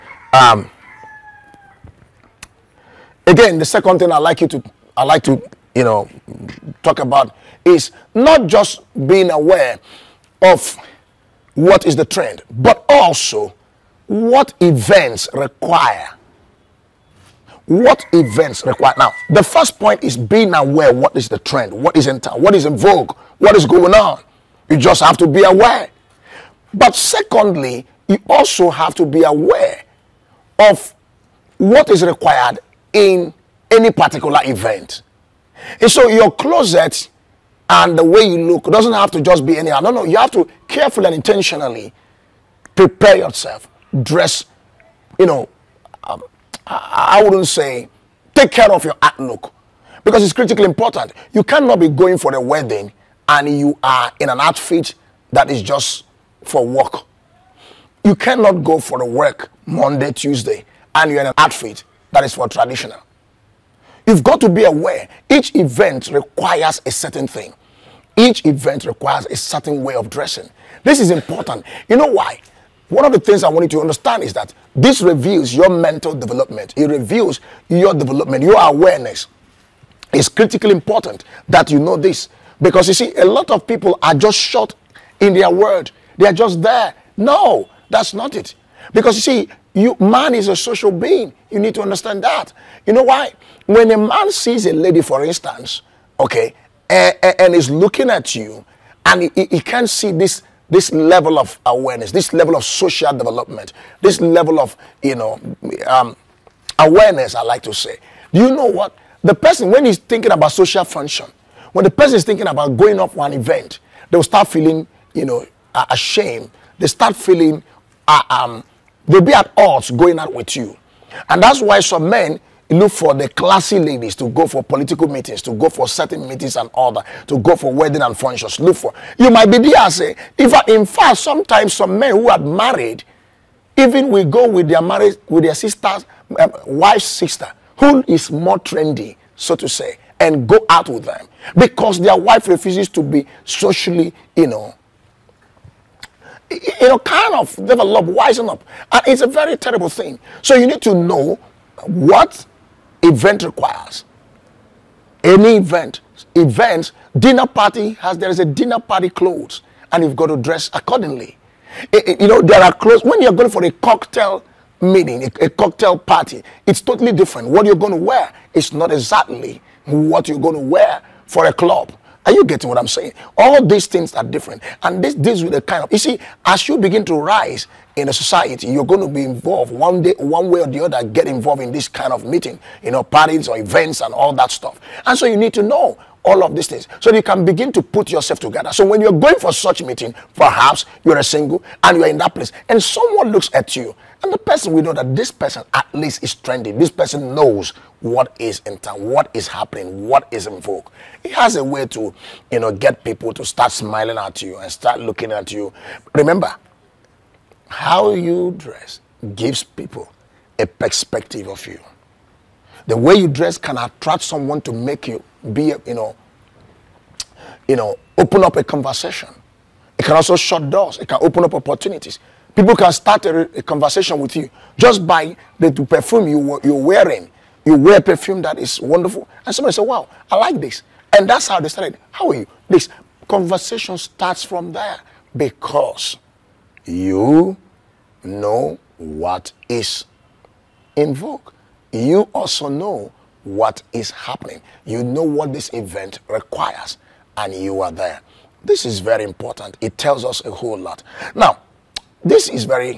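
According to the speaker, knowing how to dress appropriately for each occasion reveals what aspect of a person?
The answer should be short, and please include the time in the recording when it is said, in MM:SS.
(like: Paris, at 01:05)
Mental development, at 01:15.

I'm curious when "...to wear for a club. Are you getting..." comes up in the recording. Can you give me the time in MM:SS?
02:50.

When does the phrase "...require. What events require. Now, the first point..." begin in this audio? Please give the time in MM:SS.
00:15.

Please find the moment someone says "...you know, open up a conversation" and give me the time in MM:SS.
03:37.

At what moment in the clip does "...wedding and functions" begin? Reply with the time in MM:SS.
02:07.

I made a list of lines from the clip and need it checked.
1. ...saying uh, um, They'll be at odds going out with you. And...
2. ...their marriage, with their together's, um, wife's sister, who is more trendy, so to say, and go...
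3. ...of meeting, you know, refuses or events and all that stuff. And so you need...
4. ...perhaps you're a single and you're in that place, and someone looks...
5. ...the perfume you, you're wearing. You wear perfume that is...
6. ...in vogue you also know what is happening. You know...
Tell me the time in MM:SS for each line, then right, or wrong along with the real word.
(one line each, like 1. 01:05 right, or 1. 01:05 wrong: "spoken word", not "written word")
1. 01:57 wrong: "feeling", not "saying"
2. 02:14 wrong: "sister", not "together"
3. 03:02 wrong: "parties", not "refuses"
4. 03:10 right
5. 03:45 right
6. 04:00 right.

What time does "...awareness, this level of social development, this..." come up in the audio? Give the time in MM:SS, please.
01:41.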